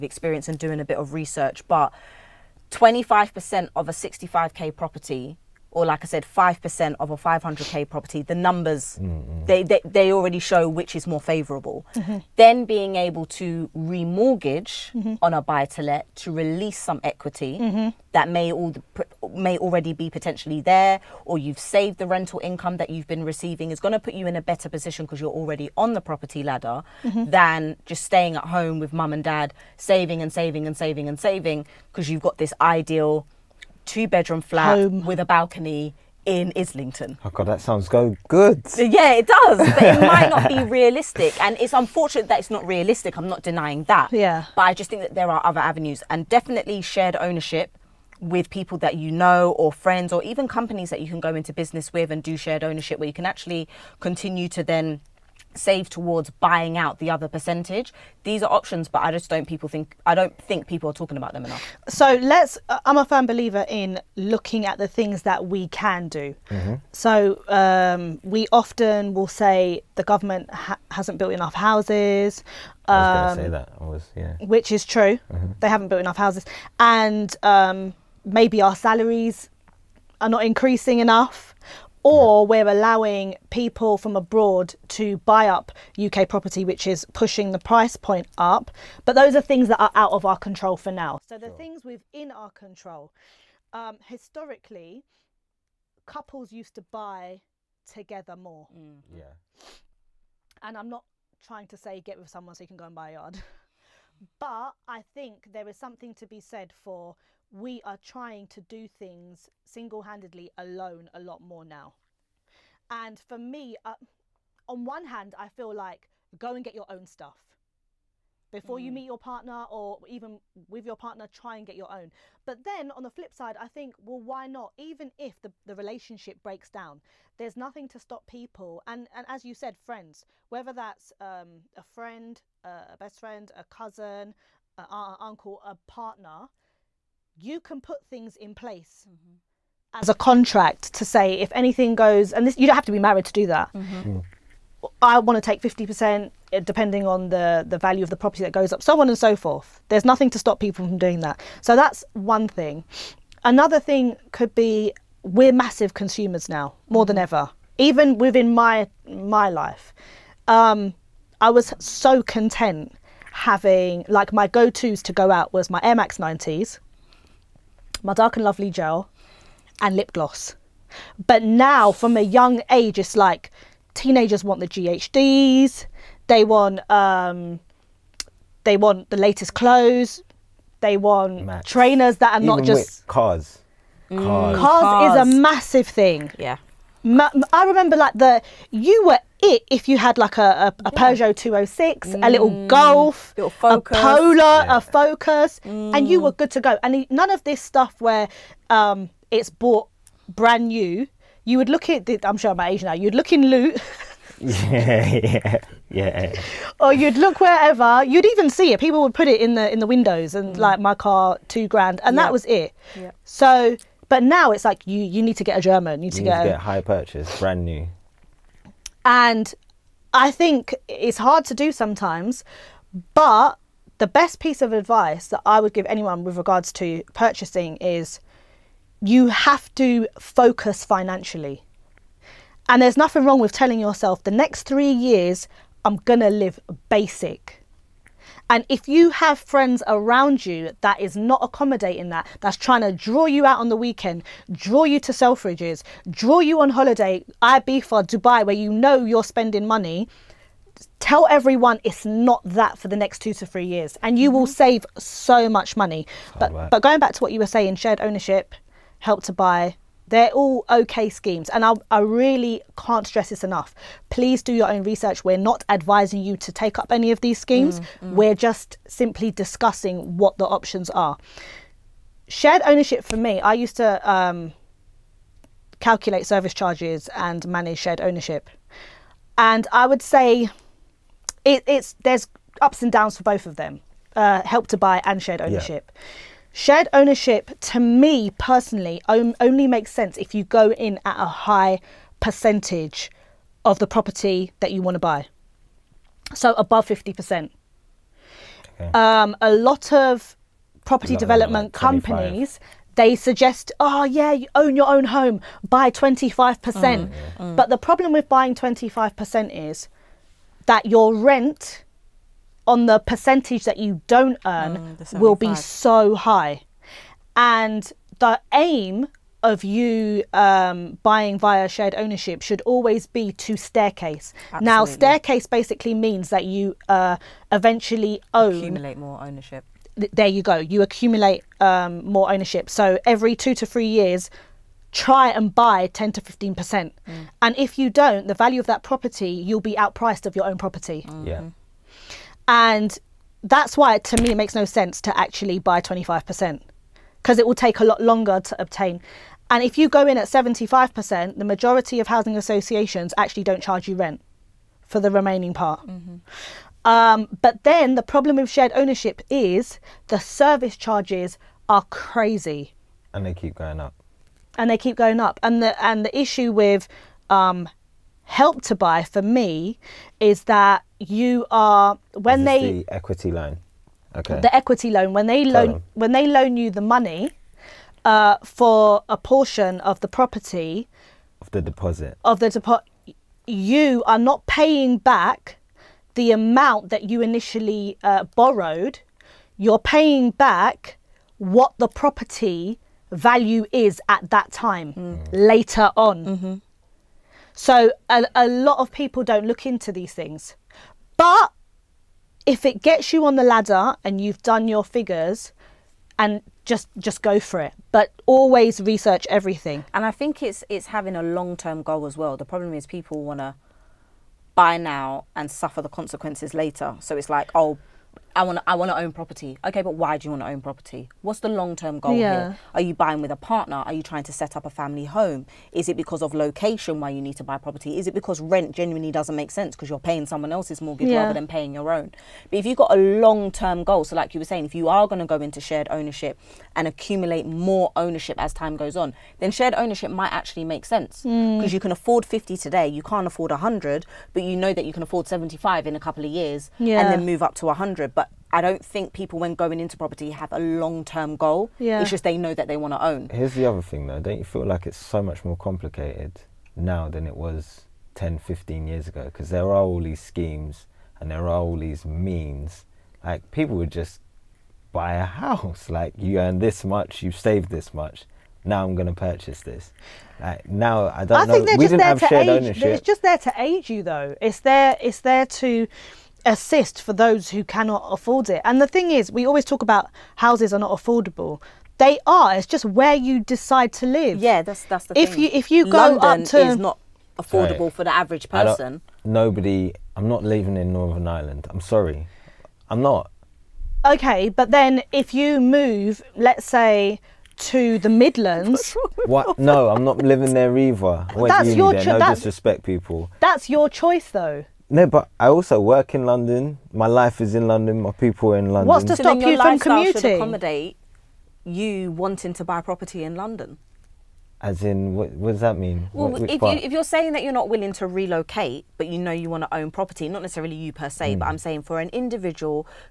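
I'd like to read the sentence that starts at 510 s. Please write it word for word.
Should accommodate you wanting to buy property in London.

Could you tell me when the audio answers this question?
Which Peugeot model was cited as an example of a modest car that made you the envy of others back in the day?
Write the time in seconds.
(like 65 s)
191 s.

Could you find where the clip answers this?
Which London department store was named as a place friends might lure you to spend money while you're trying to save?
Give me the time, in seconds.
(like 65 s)
245 s.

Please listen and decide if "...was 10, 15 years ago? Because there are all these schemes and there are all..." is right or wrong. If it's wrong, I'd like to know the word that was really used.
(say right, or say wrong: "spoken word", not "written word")
right.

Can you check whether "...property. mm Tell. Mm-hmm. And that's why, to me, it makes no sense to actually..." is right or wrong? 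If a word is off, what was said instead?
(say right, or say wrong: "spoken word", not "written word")
wrong: "Yeah", not "Tell".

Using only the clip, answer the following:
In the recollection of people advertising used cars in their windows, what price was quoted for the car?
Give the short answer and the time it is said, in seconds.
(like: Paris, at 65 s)
Two grand, at 211 s.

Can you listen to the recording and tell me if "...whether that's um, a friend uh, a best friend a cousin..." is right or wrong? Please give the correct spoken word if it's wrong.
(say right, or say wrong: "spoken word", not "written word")
right.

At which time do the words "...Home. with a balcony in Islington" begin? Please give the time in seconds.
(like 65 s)
34 s.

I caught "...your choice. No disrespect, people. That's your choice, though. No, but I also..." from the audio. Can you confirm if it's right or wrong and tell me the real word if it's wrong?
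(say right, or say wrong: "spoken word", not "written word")
right.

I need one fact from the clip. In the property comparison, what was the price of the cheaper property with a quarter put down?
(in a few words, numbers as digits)
65k.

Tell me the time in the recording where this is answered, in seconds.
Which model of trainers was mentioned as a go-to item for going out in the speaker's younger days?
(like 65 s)
165 s.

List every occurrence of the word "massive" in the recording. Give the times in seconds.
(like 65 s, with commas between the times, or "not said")
155 s, 185 s.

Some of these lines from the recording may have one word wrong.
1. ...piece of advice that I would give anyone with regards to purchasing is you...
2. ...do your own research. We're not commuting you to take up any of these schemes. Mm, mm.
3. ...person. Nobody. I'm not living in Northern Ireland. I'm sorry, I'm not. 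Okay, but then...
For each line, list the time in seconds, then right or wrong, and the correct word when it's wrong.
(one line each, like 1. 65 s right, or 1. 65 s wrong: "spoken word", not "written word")
1. 224 s right
2. 264 s wrong: "advising", not "commuting"
3. 488 s right.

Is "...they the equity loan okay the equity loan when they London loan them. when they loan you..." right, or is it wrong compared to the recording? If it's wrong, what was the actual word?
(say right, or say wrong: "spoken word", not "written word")
wrong: "Tell", not "London".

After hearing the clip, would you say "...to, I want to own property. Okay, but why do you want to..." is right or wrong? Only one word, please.
right.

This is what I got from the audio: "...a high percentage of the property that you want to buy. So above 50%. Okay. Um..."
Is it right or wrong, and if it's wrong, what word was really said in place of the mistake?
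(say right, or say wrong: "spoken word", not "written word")
right.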